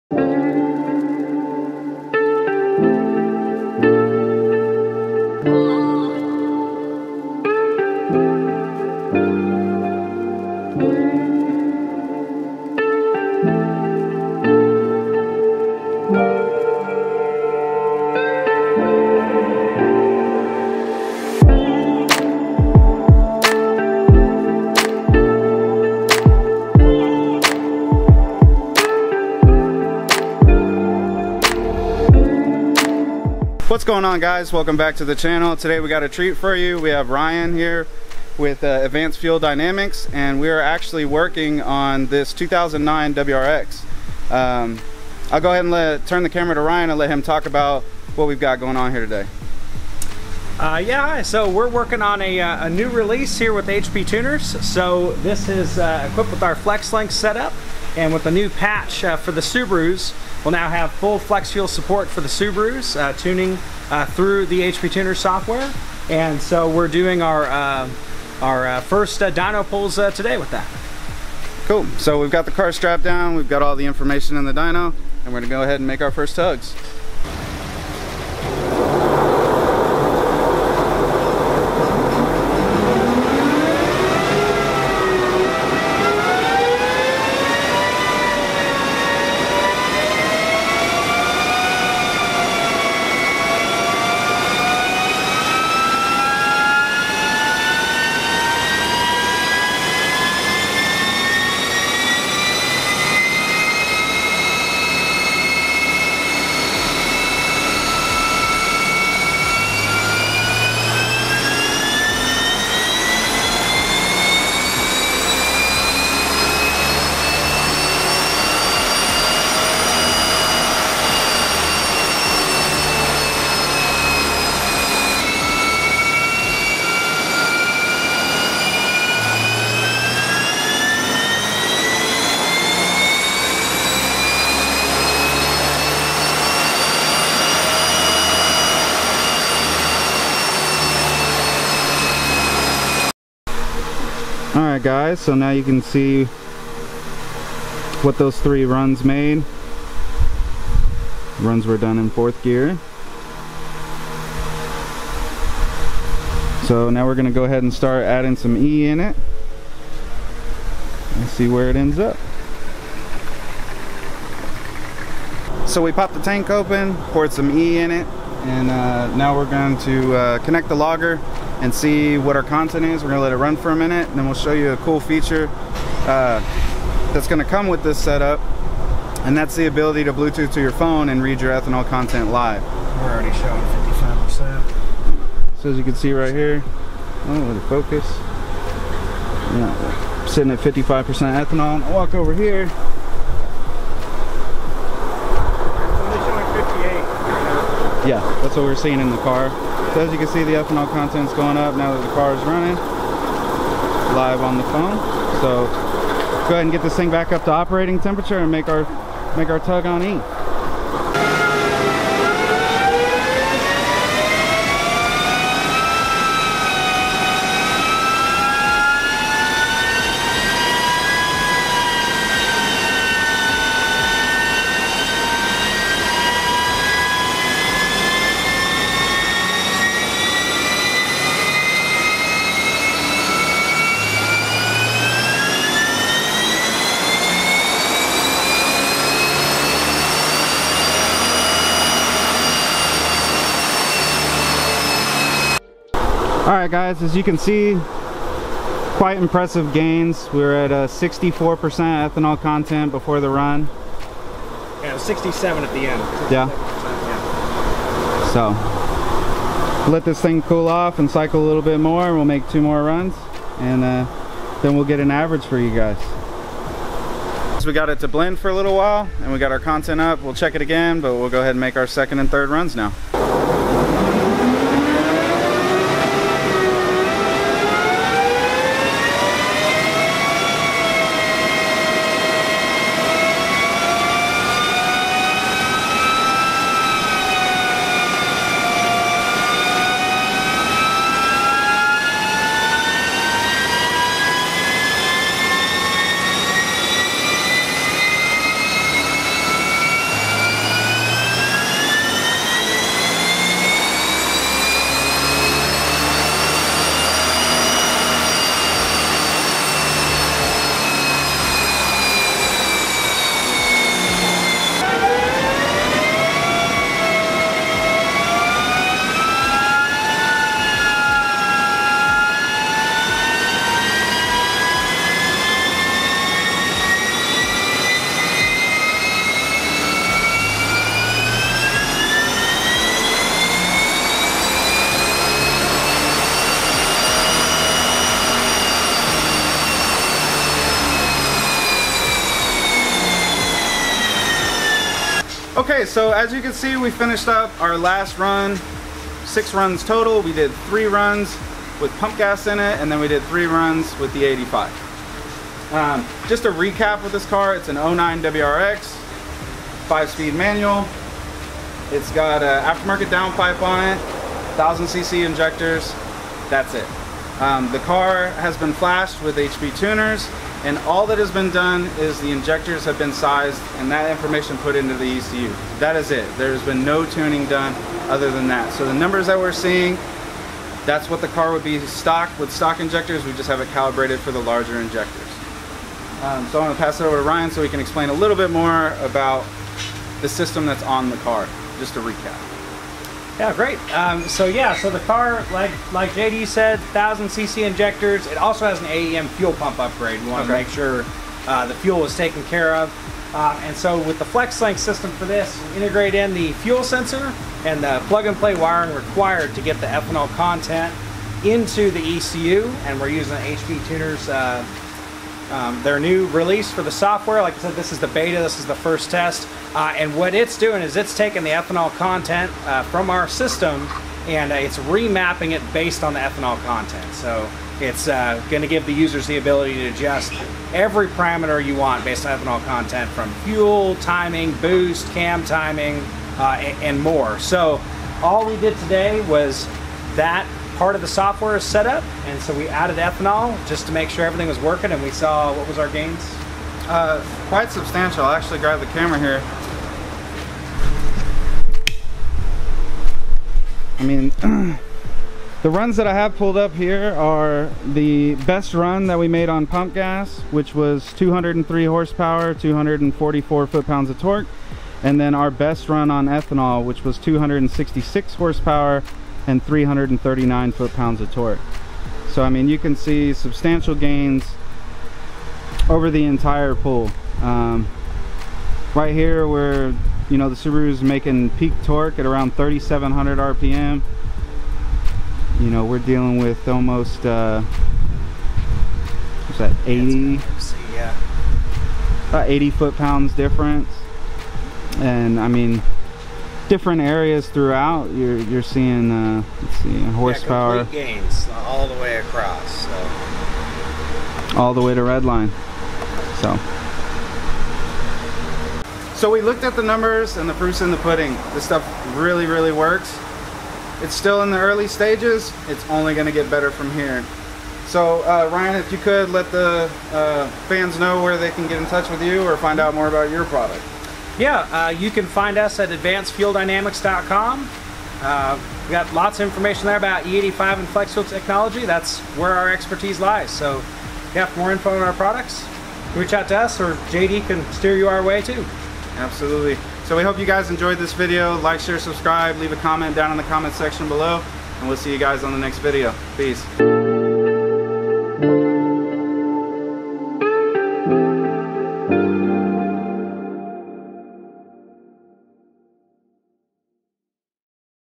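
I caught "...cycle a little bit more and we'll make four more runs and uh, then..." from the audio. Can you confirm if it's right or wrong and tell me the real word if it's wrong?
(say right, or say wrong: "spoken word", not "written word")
wrong: "two", not "four".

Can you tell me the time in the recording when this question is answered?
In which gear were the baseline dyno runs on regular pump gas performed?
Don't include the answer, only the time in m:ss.
2:32.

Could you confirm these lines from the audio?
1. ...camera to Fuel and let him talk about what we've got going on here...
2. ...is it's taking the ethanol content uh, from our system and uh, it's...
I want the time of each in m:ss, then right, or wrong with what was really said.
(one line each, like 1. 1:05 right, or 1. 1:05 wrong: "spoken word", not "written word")
1. 0:46 wrong: "Ryan", not "Fuel"
2. 7:00 right.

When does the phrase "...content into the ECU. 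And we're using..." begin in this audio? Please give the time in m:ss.
6:50.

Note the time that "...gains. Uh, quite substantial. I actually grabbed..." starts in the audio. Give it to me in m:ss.
7:25.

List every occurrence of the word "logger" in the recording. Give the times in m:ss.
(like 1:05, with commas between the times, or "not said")
2:50.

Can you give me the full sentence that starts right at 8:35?
It's only going to get better from here.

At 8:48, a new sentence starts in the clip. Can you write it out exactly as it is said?
Uh, we got lots of information there about E85 and flex fuel technology.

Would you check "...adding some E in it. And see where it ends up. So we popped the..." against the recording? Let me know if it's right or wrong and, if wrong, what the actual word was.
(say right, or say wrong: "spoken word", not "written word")
right.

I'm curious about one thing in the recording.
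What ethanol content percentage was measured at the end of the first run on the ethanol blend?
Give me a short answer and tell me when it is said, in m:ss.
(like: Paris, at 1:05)
67%, at 4:14.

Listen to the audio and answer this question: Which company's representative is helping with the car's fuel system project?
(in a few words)
Advanced Fuel Dynamics.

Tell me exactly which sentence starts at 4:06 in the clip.
All right guys, as you can see, quite impressive gains.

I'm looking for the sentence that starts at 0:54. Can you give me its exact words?
So this is uh, equipped with our FlexLink setup and with a new patch uh, for the Subarus.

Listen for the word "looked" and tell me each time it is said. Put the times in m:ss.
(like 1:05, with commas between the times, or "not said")
8:29.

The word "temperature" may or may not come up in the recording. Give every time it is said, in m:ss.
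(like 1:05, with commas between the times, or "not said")
3:27.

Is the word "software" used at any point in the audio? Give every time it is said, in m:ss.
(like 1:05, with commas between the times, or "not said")
1:05, 6:56, 7:21.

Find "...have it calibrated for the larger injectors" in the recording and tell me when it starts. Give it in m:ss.
6:23.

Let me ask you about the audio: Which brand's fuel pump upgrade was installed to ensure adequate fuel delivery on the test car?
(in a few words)
AEM.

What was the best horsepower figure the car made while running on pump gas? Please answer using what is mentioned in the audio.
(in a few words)
203 horsepower.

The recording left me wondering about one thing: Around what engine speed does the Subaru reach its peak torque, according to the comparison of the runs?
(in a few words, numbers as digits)
3700 RPM.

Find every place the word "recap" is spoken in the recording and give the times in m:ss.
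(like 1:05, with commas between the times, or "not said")
5:56, 6:32.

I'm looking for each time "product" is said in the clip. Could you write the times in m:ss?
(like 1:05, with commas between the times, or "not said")
8:43, 8:55.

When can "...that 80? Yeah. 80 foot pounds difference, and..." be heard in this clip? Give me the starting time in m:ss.
8:09.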